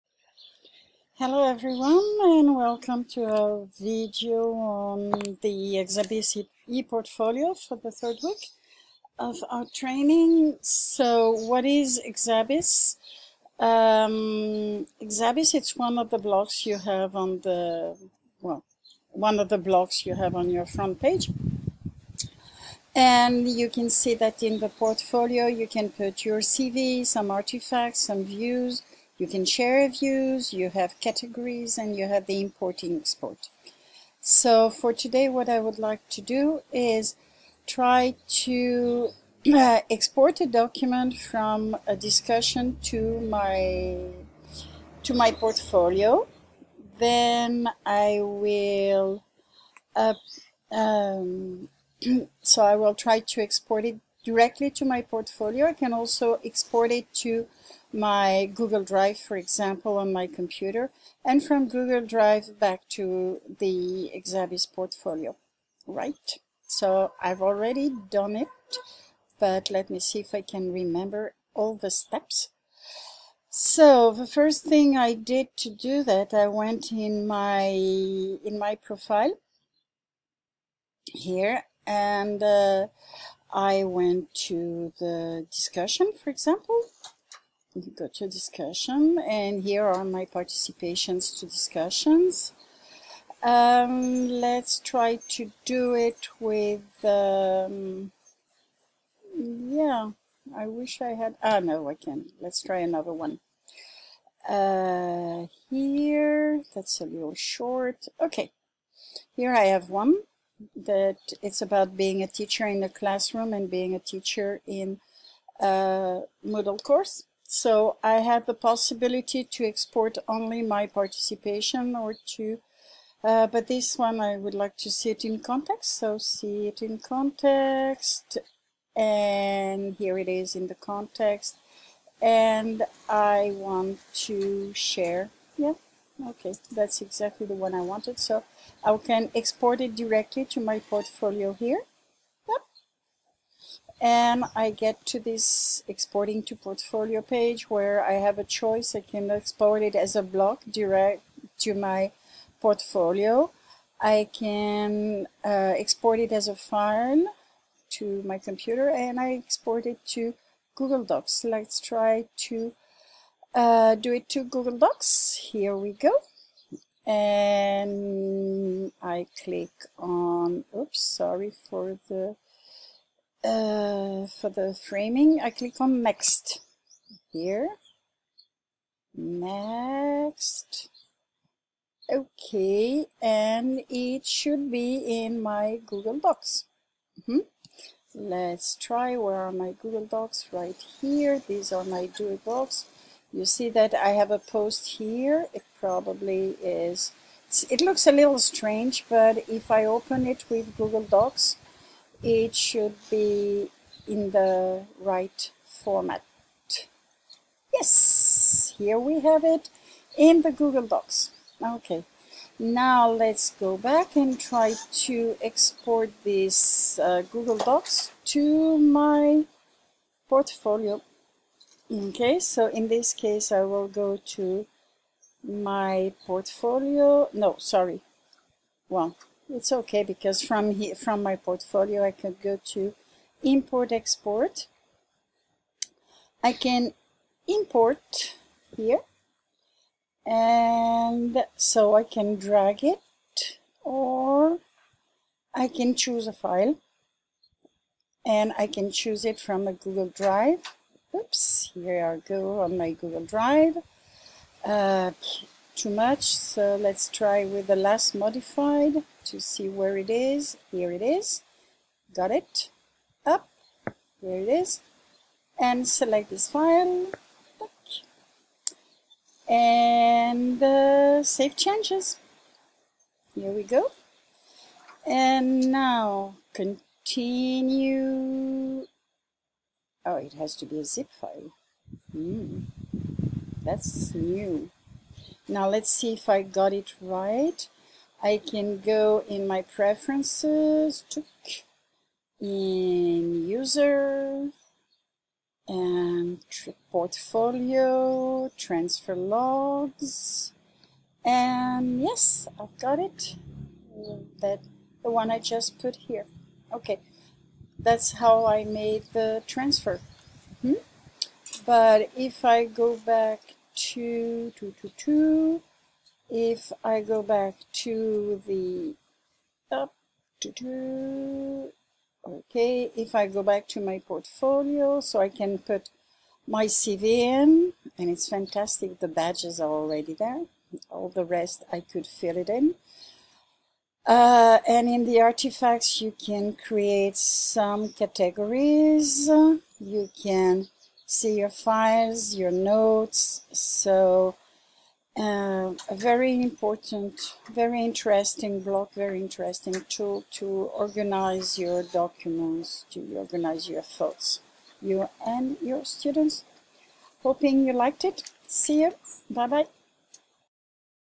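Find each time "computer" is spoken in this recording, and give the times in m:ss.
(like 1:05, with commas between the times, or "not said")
1:00, 2:38.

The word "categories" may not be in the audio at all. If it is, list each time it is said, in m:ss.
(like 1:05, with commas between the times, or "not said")
0:30, 5:37.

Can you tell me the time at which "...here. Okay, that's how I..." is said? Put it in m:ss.
5:05.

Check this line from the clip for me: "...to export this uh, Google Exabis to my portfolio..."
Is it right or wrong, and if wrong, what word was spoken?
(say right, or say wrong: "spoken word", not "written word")
wrong: "Docs", not "Exabis".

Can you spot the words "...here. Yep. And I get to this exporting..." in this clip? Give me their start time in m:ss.
2:21.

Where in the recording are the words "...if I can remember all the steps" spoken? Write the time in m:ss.
1:10.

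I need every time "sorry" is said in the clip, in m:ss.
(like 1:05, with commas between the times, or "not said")
2:51, 3:47.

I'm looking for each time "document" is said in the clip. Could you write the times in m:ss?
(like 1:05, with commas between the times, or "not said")
0:40, 5:51.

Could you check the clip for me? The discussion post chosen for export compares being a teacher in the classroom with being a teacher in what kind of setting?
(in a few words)
a Moodle course.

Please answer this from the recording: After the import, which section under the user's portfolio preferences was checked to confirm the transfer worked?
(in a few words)
transfer logs.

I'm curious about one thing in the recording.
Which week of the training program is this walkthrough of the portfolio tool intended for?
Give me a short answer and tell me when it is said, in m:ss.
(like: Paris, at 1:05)
third week, at 0:07.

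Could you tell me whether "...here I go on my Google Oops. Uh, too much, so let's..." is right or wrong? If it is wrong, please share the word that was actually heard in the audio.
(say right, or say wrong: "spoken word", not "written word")
wrong: "Drive", not "Oops".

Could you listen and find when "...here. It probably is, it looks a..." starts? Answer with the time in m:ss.
3:14.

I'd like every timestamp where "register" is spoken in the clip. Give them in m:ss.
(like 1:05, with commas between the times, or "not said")
not said.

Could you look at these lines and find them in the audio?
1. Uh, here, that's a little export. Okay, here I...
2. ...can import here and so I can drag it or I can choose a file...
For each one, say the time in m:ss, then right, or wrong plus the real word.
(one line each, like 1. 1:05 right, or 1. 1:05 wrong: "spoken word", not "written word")
1. 1:44 wrong: "short", not "export"
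2. 3:56 right.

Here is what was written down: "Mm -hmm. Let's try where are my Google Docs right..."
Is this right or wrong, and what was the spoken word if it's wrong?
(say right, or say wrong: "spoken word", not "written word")
right.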